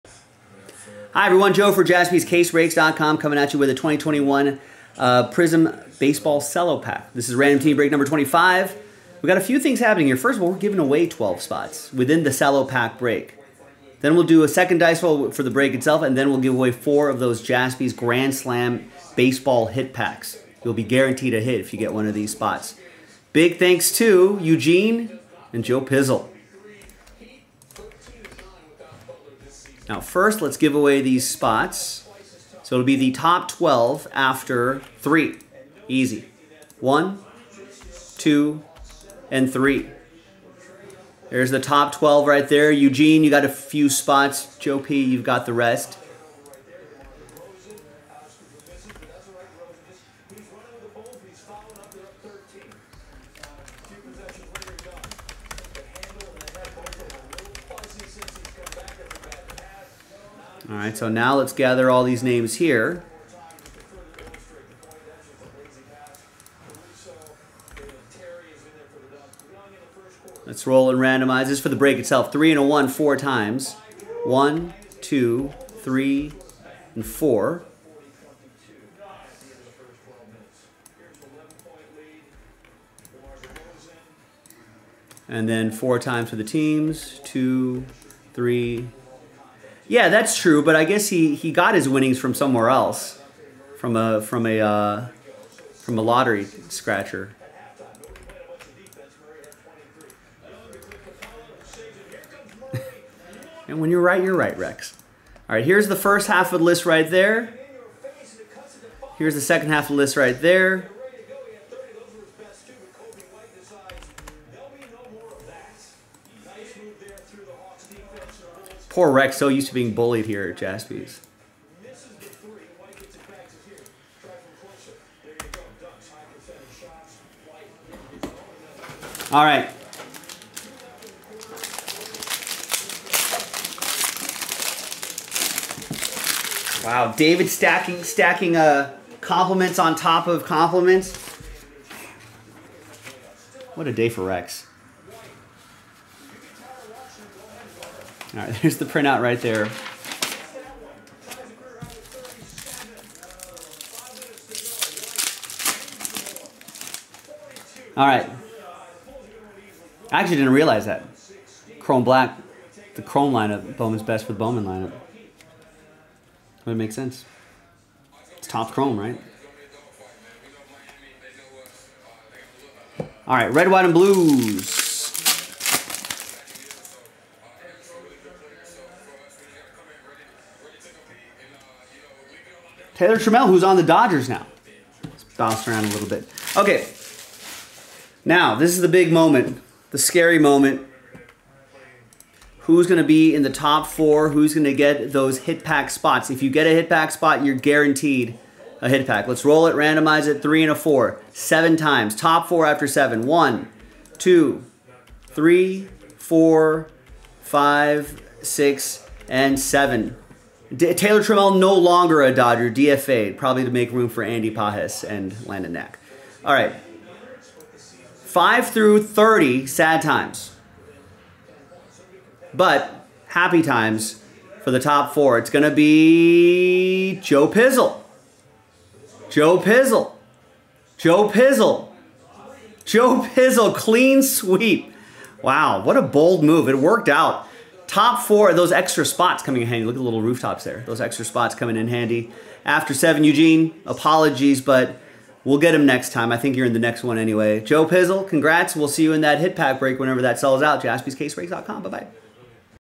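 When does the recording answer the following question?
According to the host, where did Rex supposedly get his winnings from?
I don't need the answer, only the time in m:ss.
1:35.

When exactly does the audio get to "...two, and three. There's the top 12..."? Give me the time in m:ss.
0:38.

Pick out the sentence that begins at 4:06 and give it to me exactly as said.
I think you're in the next one anyway.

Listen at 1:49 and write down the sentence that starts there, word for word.
Here's the second half of the list right there.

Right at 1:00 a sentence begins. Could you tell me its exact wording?
All right, so now let's gather all these names here.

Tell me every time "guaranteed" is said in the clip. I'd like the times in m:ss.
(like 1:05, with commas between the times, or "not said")
0:20, 3:17.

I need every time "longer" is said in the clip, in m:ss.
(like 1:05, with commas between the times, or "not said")
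3:31.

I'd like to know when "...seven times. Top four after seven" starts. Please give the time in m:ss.
3:21.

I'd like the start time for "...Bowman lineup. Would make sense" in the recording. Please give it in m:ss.
2:44.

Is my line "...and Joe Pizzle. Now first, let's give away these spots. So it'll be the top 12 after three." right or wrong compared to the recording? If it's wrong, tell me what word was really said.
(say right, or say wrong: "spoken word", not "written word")
right.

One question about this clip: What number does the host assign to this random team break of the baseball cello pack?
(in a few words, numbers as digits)
25.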